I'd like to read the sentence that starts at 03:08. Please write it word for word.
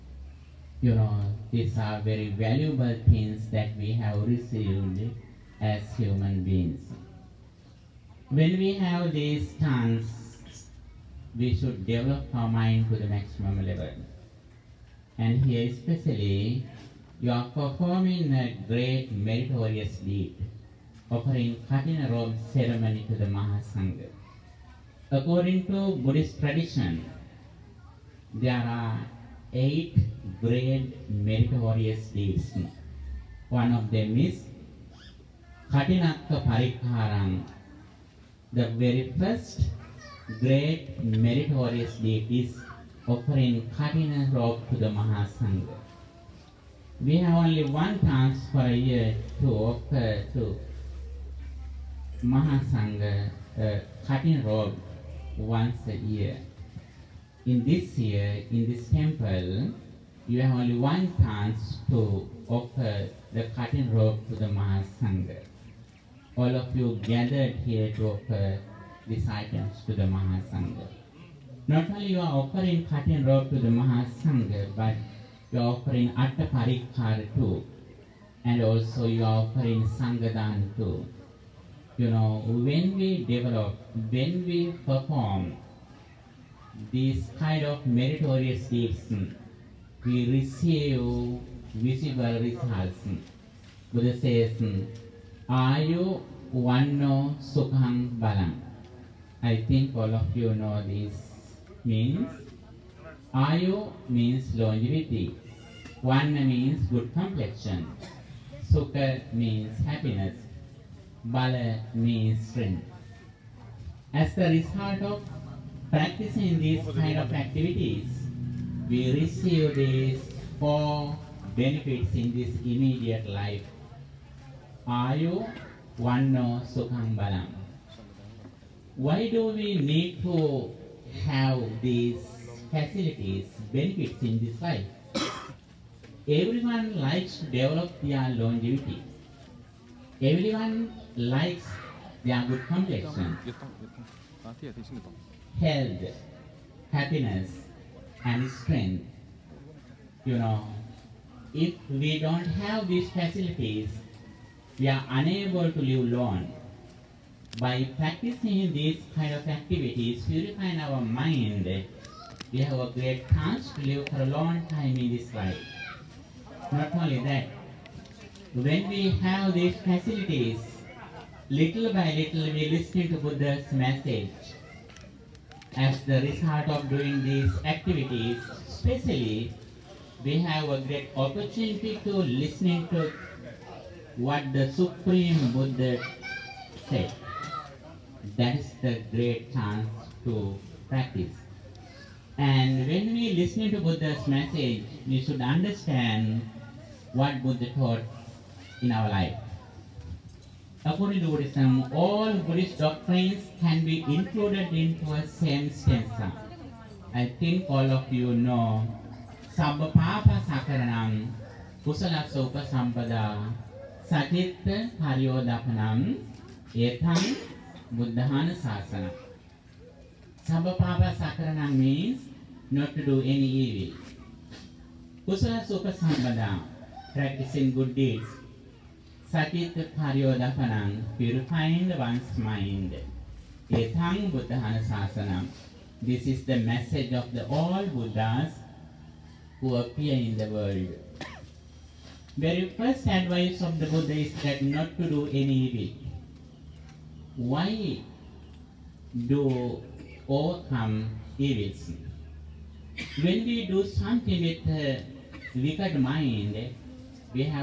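That is the great chance to practice.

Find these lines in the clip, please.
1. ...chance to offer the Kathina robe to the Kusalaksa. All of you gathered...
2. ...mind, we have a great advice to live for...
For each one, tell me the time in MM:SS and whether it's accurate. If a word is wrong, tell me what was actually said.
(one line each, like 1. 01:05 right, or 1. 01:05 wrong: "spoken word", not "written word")
1. 01:01 wrong: "Mahasangha", not "Kusalaksa"
2. 02:40 wrong: "chance", not "advice".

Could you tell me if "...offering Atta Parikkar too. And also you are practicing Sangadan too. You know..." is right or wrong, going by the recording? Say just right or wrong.
wrong.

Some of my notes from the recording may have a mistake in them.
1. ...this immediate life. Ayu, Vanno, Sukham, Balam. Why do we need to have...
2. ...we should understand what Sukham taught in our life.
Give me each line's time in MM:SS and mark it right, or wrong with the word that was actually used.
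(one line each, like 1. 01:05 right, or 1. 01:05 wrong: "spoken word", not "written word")
1. 02:02 right
2. 03:15 wrong: "Buddha", not "Sukham".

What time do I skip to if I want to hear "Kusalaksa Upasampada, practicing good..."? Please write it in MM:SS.
03:45.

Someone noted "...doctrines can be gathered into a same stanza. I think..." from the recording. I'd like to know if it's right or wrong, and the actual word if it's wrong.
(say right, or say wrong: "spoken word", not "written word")
wrong: "included", not "gathered".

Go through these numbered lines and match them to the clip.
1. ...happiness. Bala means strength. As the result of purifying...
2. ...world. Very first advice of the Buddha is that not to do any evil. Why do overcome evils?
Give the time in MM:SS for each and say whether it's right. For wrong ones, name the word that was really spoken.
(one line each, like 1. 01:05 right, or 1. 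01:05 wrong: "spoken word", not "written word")
1. 01:49 wrong: "practicing", not "purifying"
2. 04:00 right.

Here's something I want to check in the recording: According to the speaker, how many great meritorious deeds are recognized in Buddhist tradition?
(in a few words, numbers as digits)
8.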